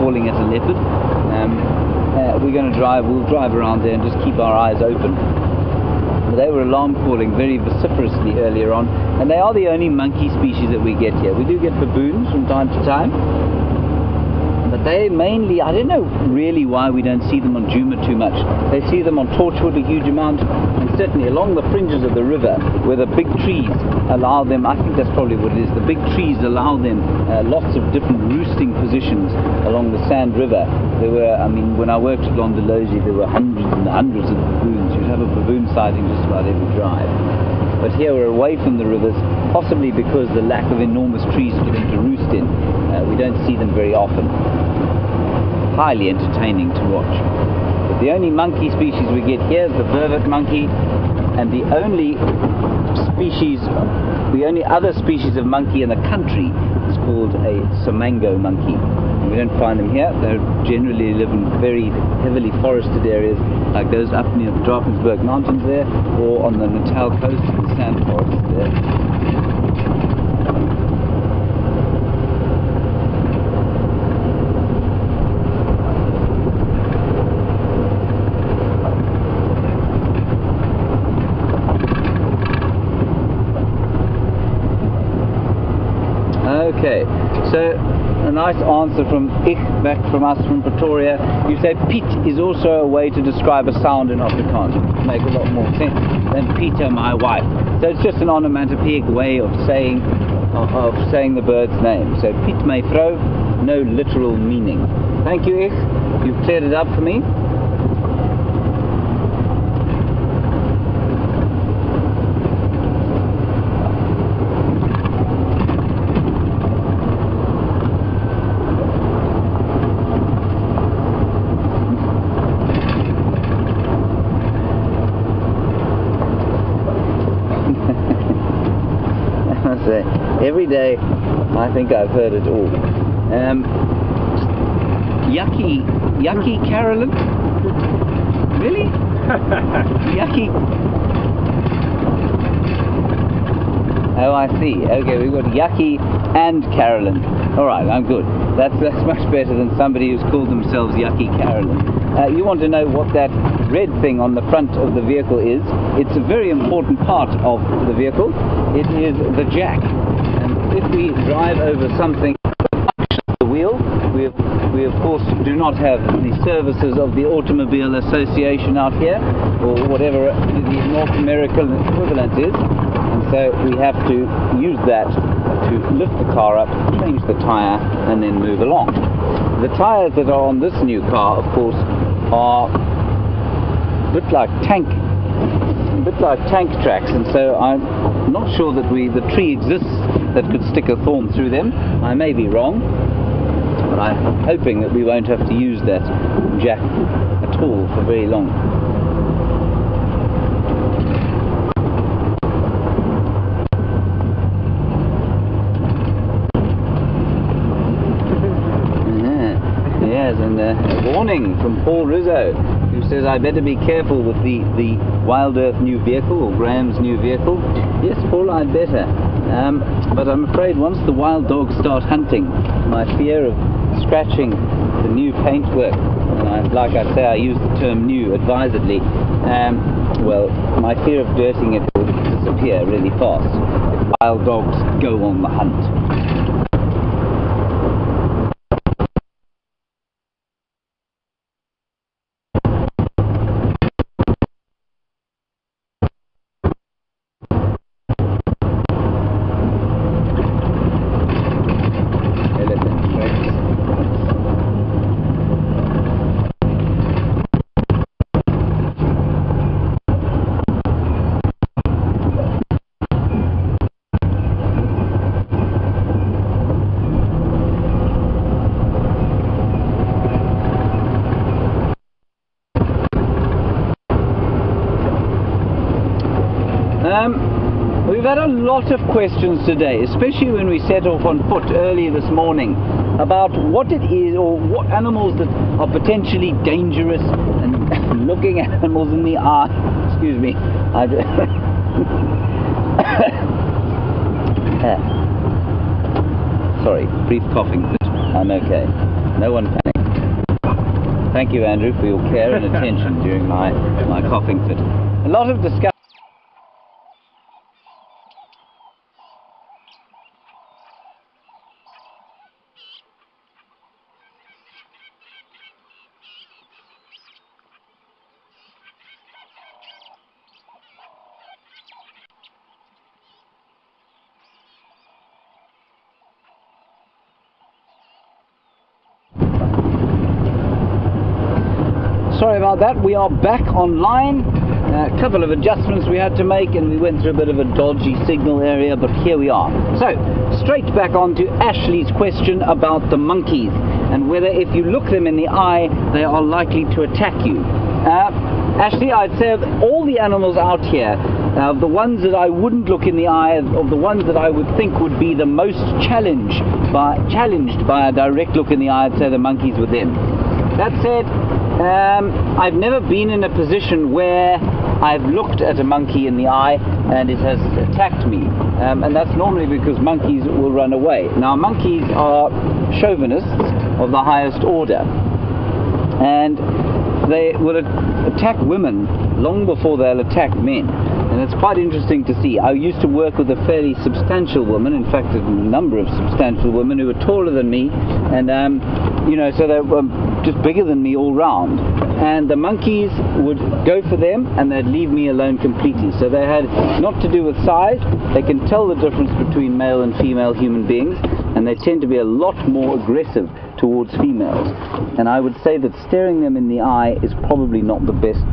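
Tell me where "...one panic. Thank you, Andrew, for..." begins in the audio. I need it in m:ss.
4:59.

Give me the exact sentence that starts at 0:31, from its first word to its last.
There were, I mean, when I worked at Londolozi, there were hundreds and hundreds of baboons.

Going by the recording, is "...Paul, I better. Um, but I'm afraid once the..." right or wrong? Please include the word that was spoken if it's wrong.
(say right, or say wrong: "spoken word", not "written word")
right.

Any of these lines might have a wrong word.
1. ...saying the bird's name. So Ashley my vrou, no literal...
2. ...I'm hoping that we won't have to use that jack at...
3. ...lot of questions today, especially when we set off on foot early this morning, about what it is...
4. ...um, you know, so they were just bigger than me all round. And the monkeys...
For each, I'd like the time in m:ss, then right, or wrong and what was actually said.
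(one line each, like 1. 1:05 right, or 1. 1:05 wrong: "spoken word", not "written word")
1. 1:41 wrong: "Piet", not "Ashley"
2. 3:14 right
3. 4:38 right
4. 6:28 right.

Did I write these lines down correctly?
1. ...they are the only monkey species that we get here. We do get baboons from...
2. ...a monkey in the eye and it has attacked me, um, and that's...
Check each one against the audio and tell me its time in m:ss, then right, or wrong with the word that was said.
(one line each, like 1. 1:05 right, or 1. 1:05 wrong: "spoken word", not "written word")
1. 0:09 right
2. 6:05 right.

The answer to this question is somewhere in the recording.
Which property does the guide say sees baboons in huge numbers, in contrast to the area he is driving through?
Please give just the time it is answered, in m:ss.
0:19.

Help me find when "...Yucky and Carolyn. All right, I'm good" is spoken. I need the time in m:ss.
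2:25.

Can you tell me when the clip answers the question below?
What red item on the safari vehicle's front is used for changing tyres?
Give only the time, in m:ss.
2:39.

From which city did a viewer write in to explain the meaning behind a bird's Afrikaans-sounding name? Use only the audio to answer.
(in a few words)
Pretoria.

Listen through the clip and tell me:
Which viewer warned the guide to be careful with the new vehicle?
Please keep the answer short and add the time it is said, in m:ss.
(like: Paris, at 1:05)
Paul Rizzo, at 3:31.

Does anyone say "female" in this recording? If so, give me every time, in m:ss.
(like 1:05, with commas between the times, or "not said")
6:40, 6:44.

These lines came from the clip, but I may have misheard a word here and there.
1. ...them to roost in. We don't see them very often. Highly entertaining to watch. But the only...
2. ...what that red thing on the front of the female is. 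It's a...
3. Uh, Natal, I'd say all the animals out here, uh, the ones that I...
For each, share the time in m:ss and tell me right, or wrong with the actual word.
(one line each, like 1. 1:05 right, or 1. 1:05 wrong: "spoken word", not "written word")
1. 0:41 right
2. 2:32 wrong: "vehicle", not "female"
3. 5:47 wrong: "Ashley", not "Natal".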